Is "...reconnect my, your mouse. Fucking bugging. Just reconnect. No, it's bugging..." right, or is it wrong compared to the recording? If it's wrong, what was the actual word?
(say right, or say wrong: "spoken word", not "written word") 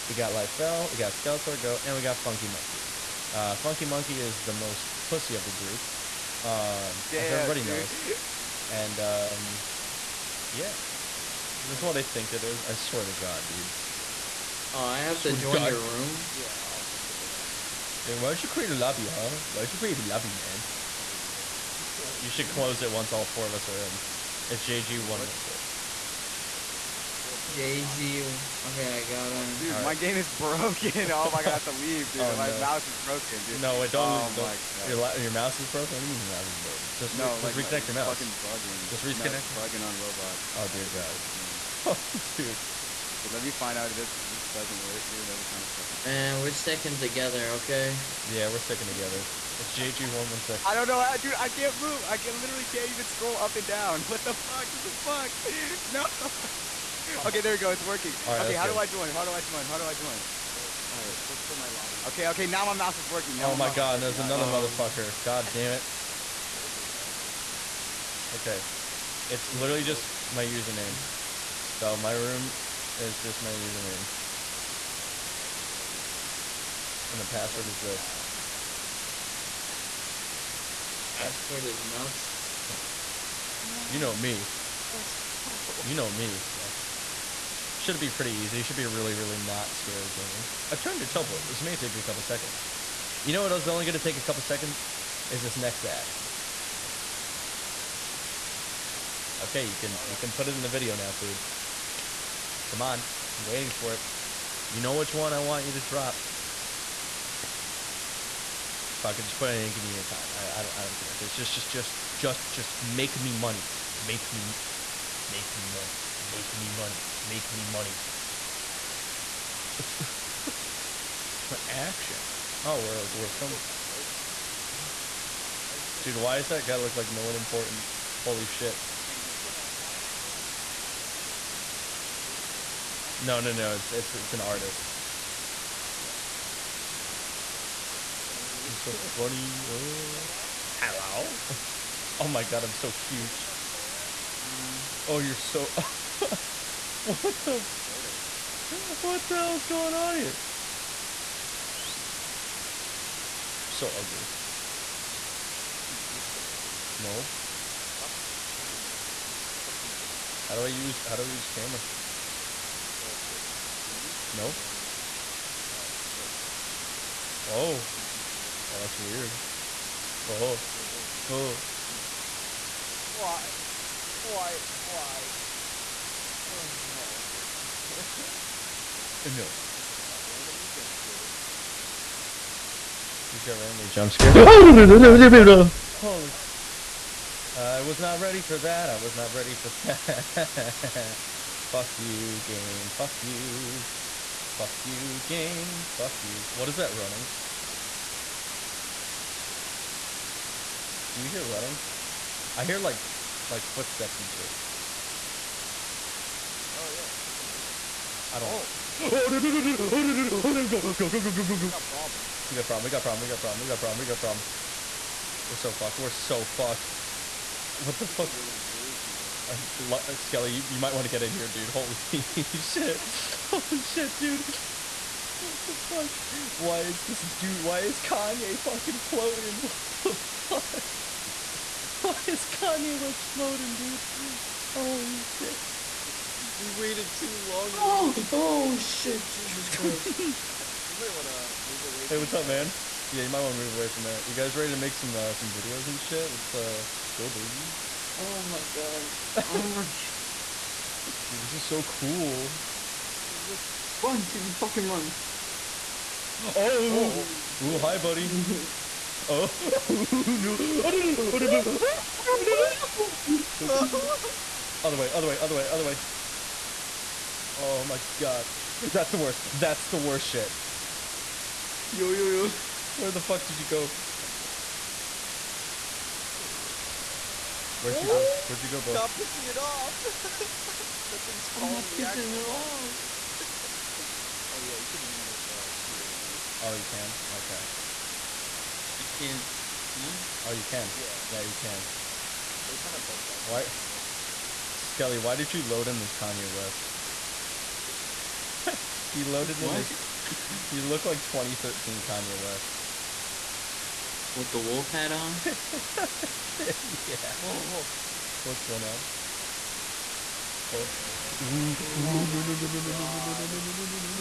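right.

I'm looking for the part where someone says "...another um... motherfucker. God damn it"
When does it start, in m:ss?
1:04.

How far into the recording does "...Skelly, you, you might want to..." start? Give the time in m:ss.
3:40.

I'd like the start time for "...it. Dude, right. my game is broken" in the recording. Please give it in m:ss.
0:29.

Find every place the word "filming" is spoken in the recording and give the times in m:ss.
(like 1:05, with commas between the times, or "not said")
2:03.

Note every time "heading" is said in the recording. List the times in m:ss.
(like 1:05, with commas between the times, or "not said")
not said.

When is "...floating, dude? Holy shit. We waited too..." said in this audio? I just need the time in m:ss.
3:53.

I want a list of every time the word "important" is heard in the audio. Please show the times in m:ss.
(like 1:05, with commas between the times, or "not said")
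2:07, 2:12.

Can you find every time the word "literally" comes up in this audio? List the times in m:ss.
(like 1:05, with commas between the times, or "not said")
0:52, 1:09.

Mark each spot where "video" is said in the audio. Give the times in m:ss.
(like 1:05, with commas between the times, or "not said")
1:40, 4:05.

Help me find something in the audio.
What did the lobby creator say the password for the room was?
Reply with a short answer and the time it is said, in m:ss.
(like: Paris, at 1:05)
nuts, at 1:21.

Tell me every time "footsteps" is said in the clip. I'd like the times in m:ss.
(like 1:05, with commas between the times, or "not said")
3:23.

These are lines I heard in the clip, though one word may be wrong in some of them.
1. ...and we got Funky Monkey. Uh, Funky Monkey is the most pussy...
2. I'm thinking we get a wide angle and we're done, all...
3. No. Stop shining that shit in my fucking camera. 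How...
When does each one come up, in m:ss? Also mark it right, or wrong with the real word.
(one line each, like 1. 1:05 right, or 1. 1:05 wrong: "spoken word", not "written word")
1. 0:01 right
2. 2:08 right
3. 2:36 right.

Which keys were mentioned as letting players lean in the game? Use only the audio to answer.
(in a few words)
Q or E.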